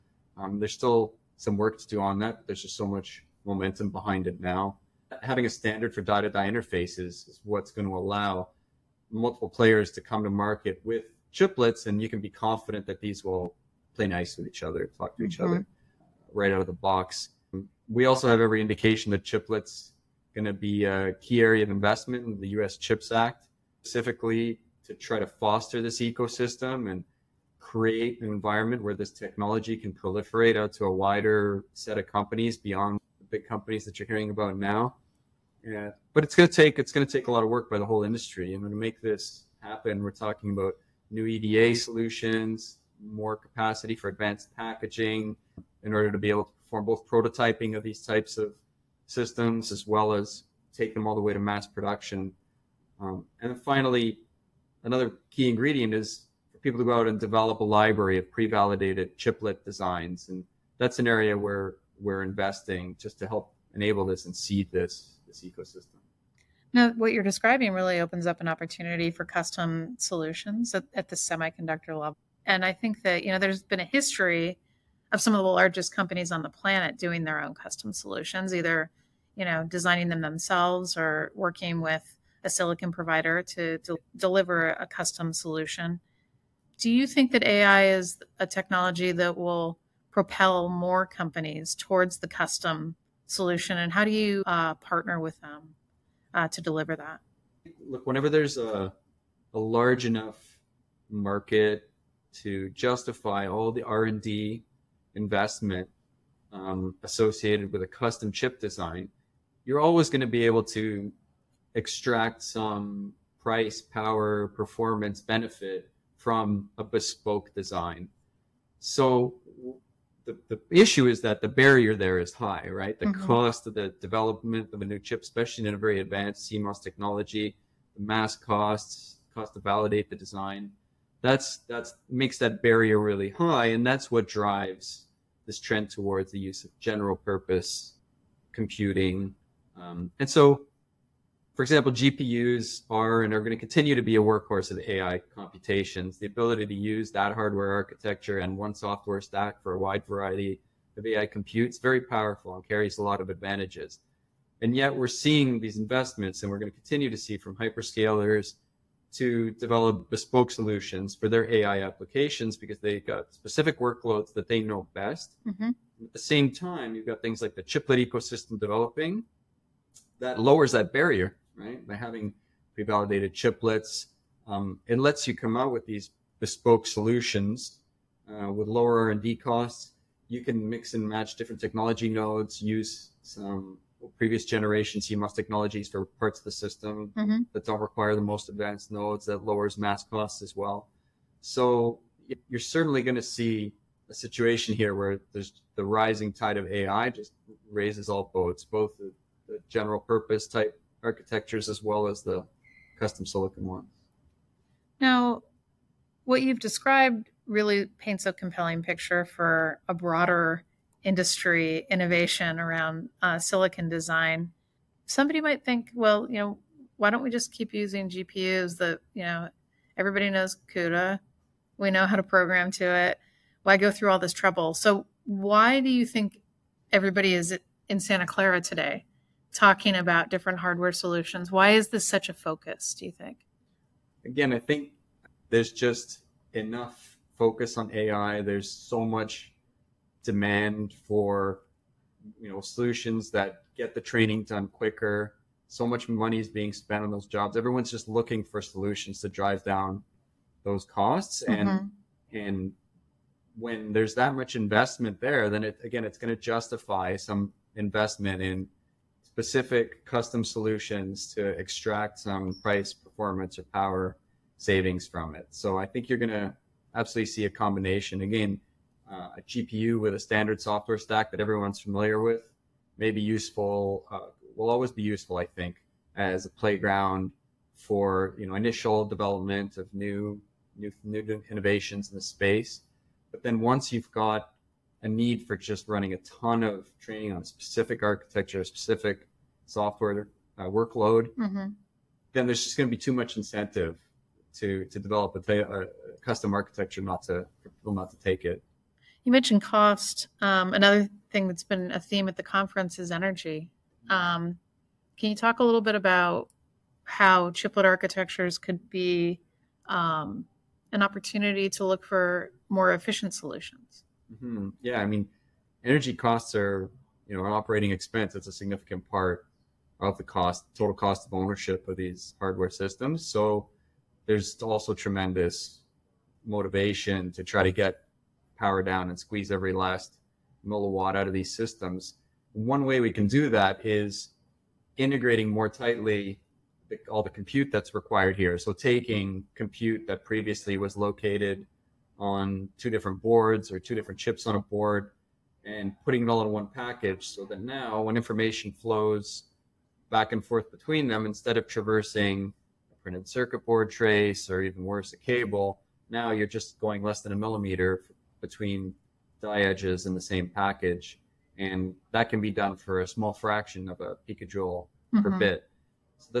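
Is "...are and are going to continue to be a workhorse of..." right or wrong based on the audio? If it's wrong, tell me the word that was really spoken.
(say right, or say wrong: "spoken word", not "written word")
right.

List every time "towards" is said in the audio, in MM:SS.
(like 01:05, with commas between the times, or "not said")
01:31, 02:15.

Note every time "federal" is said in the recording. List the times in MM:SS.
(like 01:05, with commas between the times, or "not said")
not said.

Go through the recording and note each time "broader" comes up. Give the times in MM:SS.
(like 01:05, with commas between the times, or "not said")
03:29.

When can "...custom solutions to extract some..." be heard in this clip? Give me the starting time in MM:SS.
04:20.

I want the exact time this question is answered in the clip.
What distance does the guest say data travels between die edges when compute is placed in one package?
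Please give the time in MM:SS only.
05:57.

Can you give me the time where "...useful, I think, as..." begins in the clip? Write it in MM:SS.
04:35.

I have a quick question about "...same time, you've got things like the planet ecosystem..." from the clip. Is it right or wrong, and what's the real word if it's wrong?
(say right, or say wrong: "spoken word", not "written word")
wrong: "chiplet", not "planet".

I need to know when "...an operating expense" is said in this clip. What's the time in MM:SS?
05:17.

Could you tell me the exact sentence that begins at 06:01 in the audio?
And that can be done for a small fraction of a picojoule mm-hmm.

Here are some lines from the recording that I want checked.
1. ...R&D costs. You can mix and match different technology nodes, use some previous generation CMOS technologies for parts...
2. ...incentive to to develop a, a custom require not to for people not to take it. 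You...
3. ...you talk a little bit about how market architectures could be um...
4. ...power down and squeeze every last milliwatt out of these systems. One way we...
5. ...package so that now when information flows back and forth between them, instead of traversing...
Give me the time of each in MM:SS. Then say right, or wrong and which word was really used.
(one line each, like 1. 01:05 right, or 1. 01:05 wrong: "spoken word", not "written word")
1. 02:59 right
2. 04:53 wrong: "architecture", not "require"
3. 05:05 wrong: "chiplet", not "market"
4. 05:28 right
5. 05:46 right.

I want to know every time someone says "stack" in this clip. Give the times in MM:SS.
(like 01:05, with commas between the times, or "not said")
02:29, 04:30.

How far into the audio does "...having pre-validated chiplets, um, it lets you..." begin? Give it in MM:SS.
02:51.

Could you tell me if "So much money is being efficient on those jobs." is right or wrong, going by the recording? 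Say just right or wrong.
wrong.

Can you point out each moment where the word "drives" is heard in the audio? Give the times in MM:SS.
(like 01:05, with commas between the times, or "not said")
02:14, 04:09.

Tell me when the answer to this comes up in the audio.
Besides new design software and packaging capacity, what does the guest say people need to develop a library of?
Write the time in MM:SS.
00:58.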